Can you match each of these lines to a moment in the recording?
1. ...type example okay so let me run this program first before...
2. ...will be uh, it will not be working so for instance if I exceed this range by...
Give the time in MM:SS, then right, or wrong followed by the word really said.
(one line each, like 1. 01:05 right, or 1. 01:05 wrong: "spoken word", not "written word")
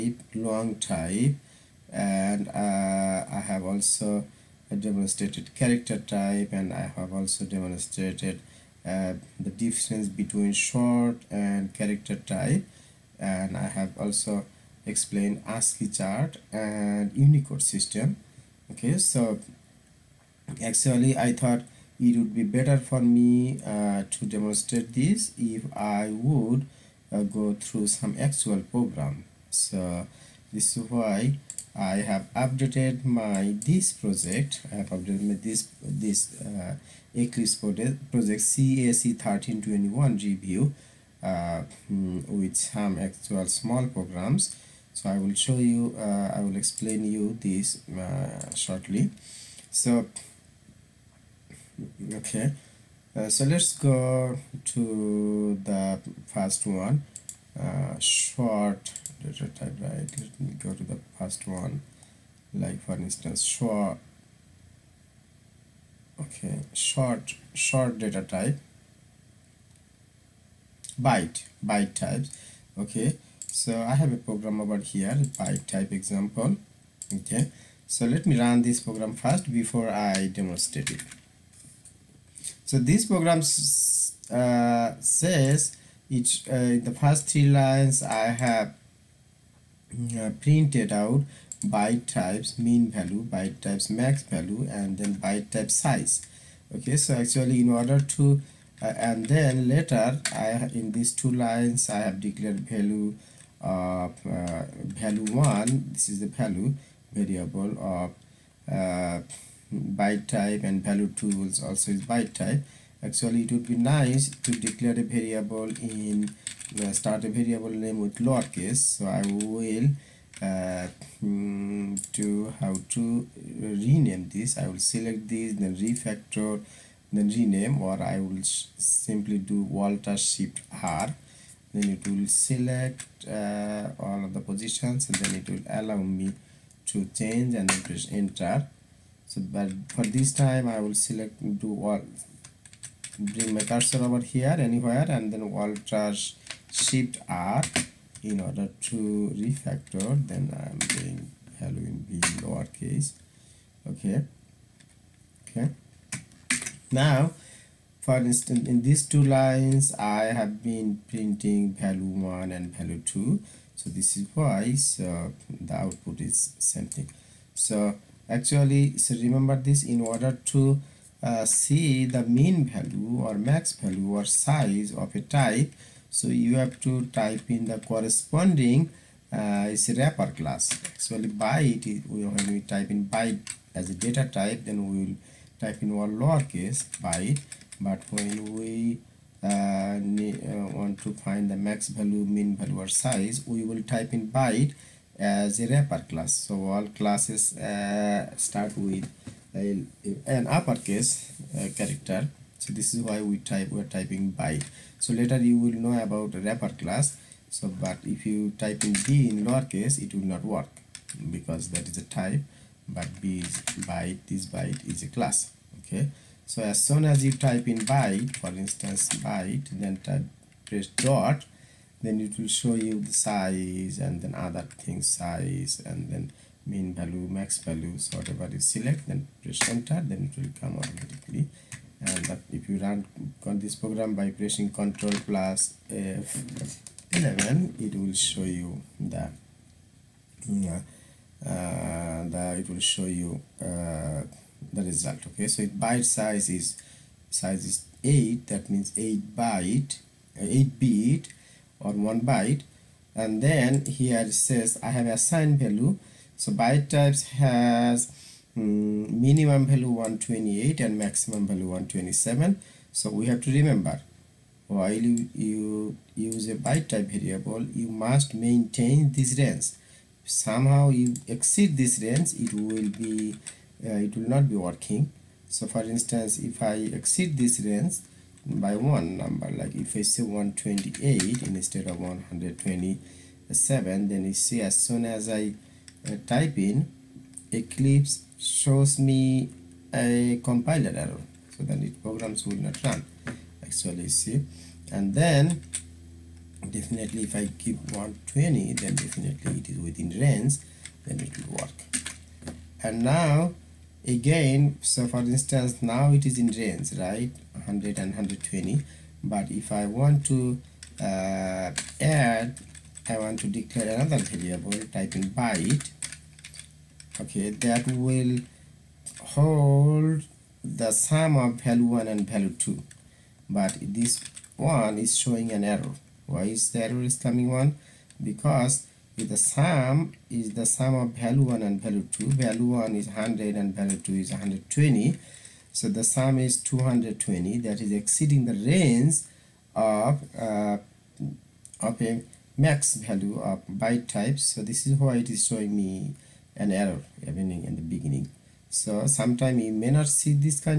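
1. 01:15 right
2. 04:32 right.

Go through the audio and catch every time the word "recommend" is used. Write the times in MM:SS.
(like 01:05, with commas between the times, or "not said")
not said.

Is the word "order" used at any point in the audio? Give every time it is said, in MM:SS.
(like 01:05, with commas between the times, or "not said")
01:37, 02:28, 02:49.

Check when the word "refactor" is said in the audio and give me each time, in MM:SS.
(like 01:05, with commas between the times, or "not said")
02:05, 02:29.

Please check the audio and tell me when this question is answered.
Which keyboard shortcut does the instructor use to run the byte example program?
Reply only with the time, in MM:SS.
03:54.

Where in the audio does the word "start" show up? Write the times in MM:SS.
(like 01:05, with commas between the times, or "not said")
01:56, 03:18.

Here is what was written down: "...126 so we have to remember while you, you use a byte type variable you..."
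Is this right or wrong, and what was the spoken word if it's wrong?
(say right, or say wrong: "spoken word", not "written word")
wrong: "127", not "126".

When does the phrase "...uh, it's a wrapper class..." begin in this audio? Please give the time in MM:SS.
02:59.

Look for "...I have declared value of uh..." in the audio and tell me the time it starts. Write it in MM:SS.
01:41.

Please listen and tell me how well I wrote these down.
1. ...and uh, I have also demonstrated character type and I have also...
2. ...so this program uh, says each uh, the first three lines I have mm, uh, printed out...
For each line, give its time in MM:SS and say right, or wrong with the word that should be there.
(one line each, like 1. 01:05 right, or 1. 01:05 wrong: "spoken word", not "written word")
1. 00:01 right
2. 01:22 right.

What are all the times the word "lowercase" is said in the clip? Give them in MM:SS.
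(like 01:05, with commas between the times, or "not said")
01:58, 02:32, 03:06, 03:29.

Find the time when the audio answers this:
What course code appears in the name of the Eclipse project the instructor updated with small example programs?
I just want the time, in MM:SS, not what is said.
00:38.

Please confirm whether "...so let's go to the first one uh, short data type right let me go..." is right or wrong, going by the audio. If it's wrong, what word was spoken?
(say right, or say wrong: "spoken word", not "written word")
right.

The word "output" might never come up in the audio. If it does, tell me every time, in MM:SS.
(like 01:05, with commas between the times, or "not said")
02:45.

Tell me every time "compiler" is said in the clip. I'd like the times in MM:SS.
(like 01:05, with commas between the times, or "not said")
04:50.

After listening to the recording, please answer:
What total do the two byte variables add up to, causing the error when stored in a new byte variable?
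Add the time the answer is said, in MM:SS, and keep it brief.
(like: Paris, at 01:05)
220, at 05:36.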